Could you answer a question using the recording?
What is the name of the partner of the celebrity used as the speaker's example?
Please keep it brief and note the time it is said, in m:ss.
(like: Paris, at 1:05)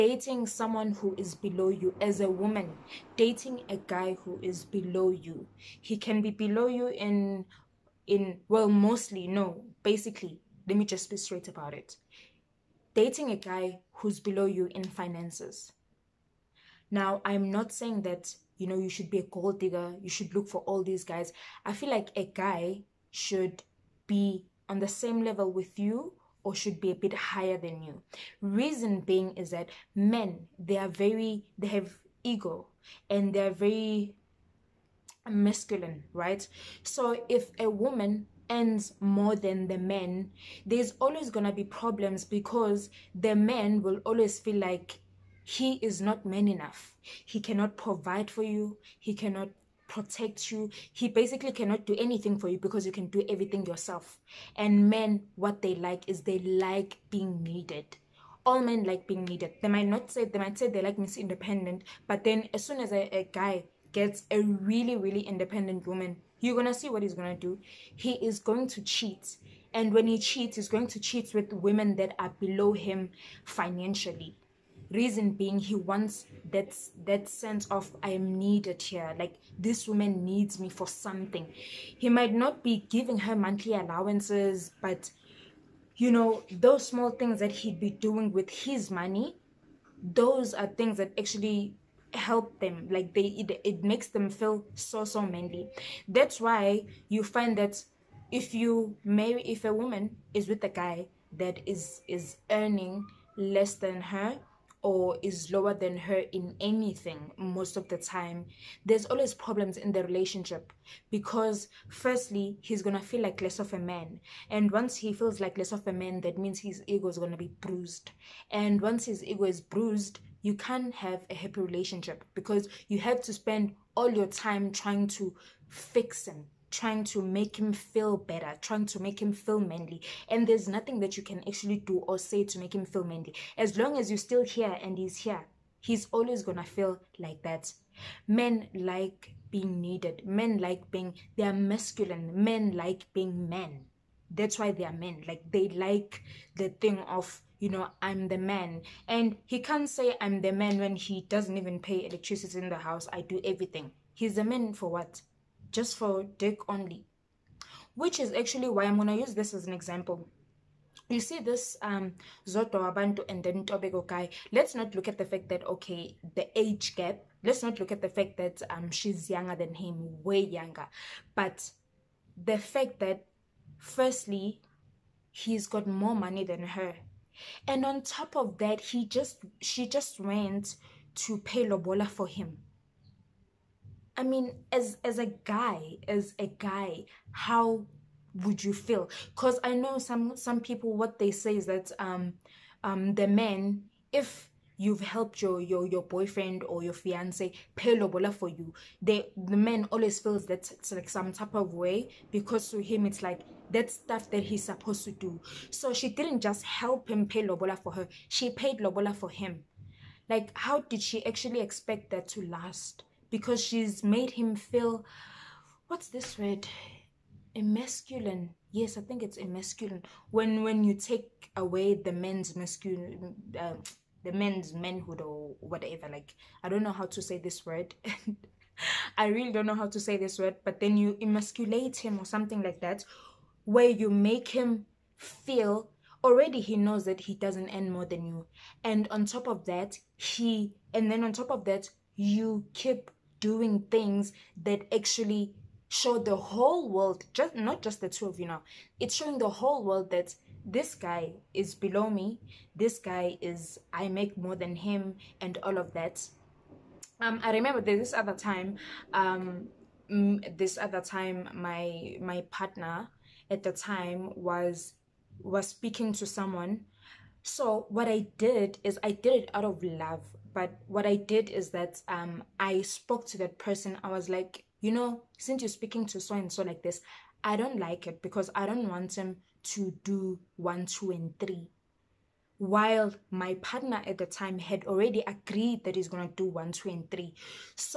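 Ntobeko, at 2:43.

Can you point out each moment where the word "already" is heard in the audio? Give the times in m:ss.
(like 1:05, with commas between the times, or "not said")
3:56, 4:44.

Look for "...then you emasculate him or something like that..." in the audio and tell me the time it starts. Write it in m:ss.
3:50.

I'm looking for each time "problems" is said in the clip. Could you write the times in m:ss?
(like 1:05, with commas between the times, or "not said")
0:41, 1:49.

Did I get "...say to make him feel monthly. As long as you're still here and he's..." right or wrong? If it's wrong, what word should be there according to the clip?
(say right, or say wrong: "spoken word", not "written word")
wrong: "manly", not "monthly".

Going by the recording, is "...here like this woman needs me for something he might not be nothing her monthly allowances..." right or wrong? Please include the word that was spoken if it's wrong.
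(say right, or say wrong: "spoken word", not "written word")
wrong: "giving", not "nothing".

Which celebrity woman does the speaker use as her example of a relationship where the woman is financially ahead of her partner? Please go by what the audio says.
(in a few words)
Zodwa Wabantu.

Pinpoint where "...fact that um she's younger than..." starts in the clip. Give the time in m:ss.
2:48.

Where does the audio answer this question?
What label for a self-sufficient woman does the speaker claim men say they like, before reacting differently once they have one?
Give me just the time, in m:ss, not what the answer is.
1:00.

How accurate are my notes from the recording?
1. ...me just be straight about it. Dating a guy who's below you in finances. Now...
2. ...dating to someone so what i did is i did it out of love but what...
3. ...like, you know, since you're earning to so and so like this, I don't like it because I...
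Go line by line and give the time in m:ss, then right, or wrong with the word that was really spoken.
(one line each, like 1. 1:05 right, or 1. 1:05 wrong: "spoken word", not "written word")
1. 0:10 right
2. 4:25 wrong: "speaking", not "dating"
3. 4:34 wrong: "speaking", not "earning".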